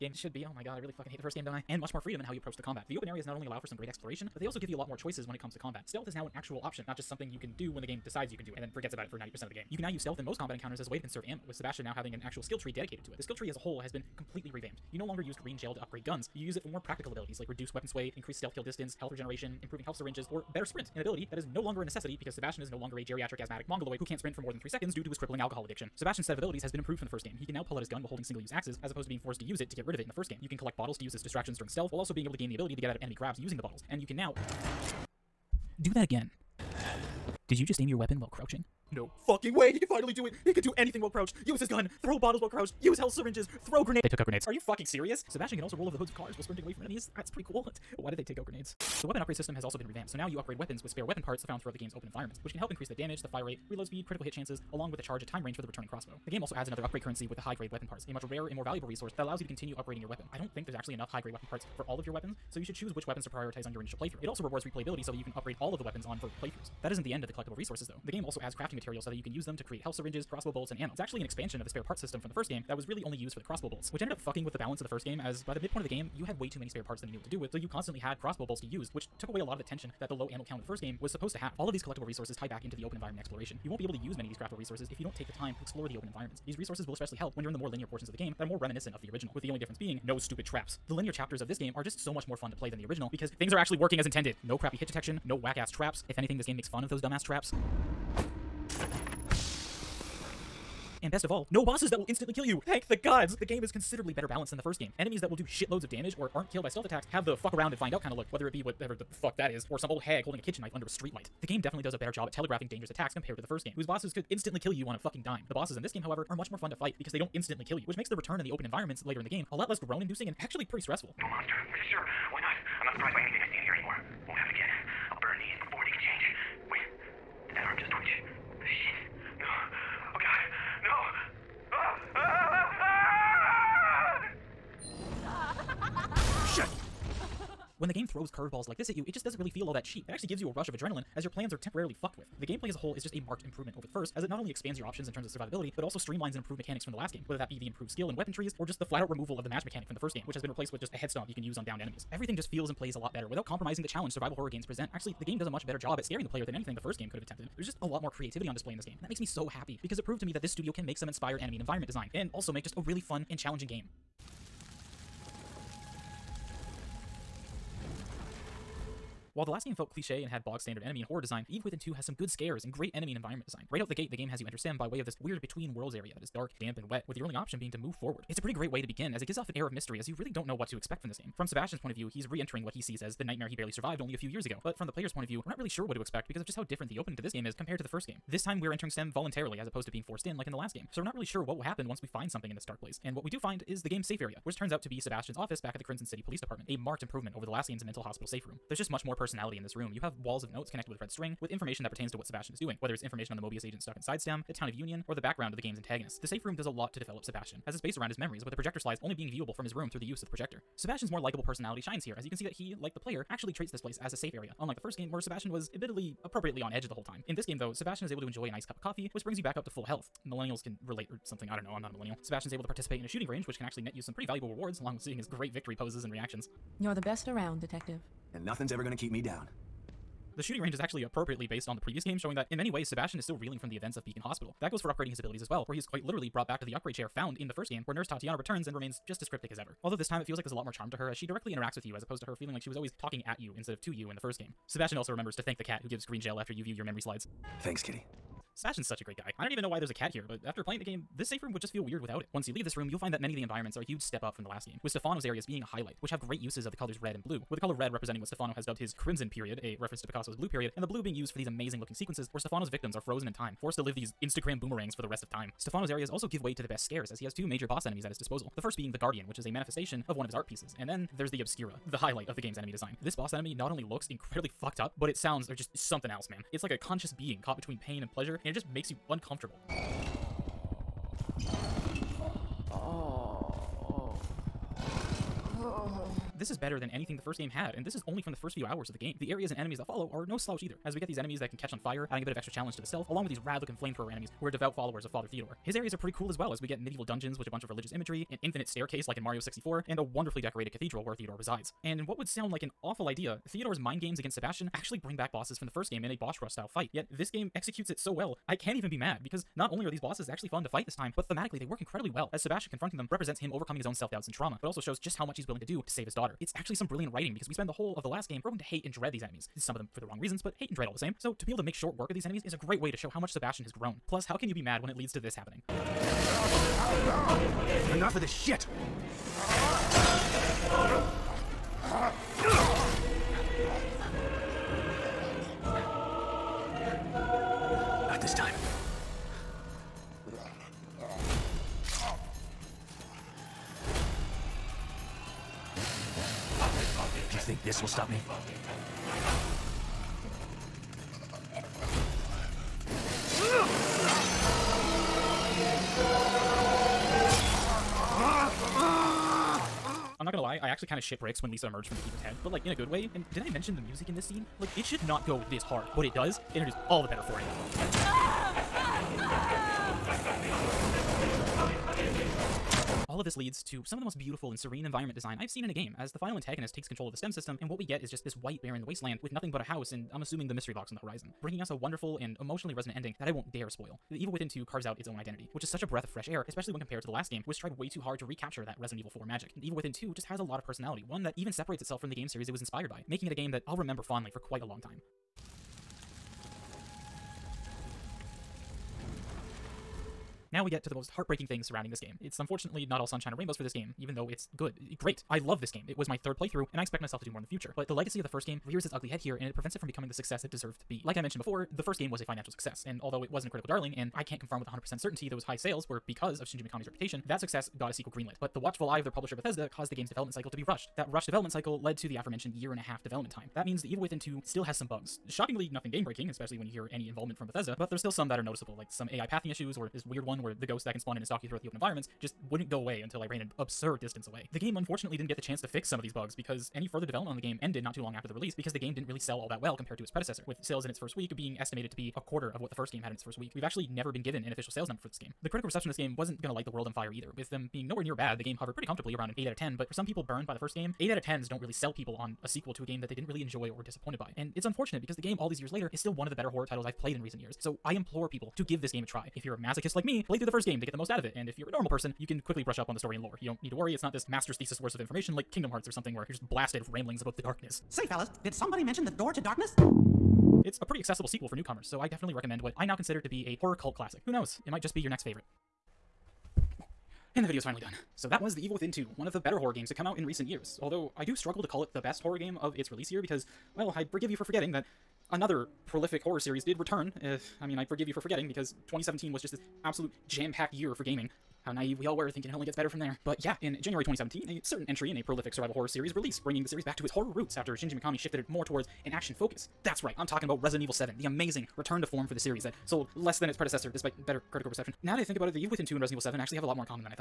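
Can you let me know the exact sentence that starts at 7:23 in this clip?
We've actually never been given an official sales number for this game.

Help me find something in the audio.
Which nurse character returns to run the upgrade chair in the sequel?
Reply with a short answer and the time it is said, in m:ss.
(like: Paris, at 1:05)
Nurse Tatiana, at 3:57.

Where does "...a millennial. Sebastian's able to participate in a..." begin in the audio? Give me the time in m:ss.
3:41.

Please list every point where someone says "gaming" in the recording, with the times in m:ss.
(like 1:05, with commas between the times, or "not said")
8:11.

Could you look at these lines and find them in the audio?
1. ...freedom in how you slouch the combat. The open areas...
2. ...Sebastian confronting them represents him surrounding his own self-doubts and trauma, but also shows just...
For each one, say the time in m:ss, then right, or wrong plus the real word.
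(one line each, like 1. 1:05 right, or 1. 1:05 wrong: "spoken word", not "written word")
1. 0:01 wrong: "approach", not "slouch"
2. 5:12 wrong: "overcoming", not "surrounding".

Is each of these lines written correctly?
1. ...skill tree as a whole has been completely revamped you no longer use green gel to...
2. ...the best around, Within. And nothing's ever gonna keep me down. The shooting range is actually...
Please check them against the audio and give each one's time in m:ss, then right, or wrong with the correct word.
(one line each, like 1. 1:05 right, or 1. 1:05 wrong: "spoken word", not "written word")
1. 0:13 right
2. 3:46 wrong: "Detective", not "Within".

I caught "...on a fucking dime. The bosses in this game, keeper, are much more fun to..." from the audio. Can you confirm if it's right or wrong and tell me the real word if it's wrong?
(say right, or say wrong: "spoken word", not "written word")
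wrong: "however", not "keeper".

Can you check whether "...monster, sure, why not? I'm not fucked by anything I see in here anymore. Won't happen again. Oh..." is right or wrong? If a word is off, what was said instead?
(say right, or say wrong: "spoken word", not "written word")
wrong: "surprised", not "fucked".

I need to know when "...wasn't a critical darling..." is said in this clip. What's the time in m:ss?
6:53.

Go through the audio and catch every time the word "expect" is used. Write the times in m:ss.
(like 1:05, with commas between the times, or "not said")
3:00, 3:06, 6:46.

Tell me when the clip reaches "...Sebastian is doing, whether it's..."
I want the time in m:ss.
3:22.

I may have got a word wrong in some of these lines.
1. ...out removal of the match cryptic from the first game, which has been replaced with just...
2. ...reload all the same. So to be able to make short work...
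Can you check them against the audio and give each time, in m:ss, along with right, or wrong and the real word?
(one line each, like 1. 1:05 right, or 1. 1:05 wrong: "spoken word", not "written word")
1. 2:29 wrong: "mechanic", not "cryptic"
2. 5:20 wrong: "dread", not "reload".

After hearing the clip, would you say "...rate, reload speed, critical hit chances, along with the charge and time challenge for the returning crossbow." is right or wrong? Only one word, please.
wrong.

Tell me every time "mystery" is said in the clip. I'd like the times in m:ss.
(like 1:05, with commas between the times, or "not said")
2:59, 6:20.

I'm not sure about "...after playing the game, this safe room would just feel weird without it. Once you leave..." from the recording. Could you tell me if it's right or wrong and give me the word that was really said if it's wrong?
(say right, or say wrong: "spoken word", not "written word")
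right.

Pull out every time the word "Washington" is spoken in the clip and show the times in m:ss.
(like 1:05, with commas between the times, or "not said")
not said.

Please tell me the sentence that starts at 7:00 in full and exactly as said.
That rushed development cycle led to the aforementioned year and a half development time.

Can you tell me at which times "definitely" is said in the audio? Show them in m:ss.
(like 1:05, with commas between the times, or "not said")
1:51, 7:52.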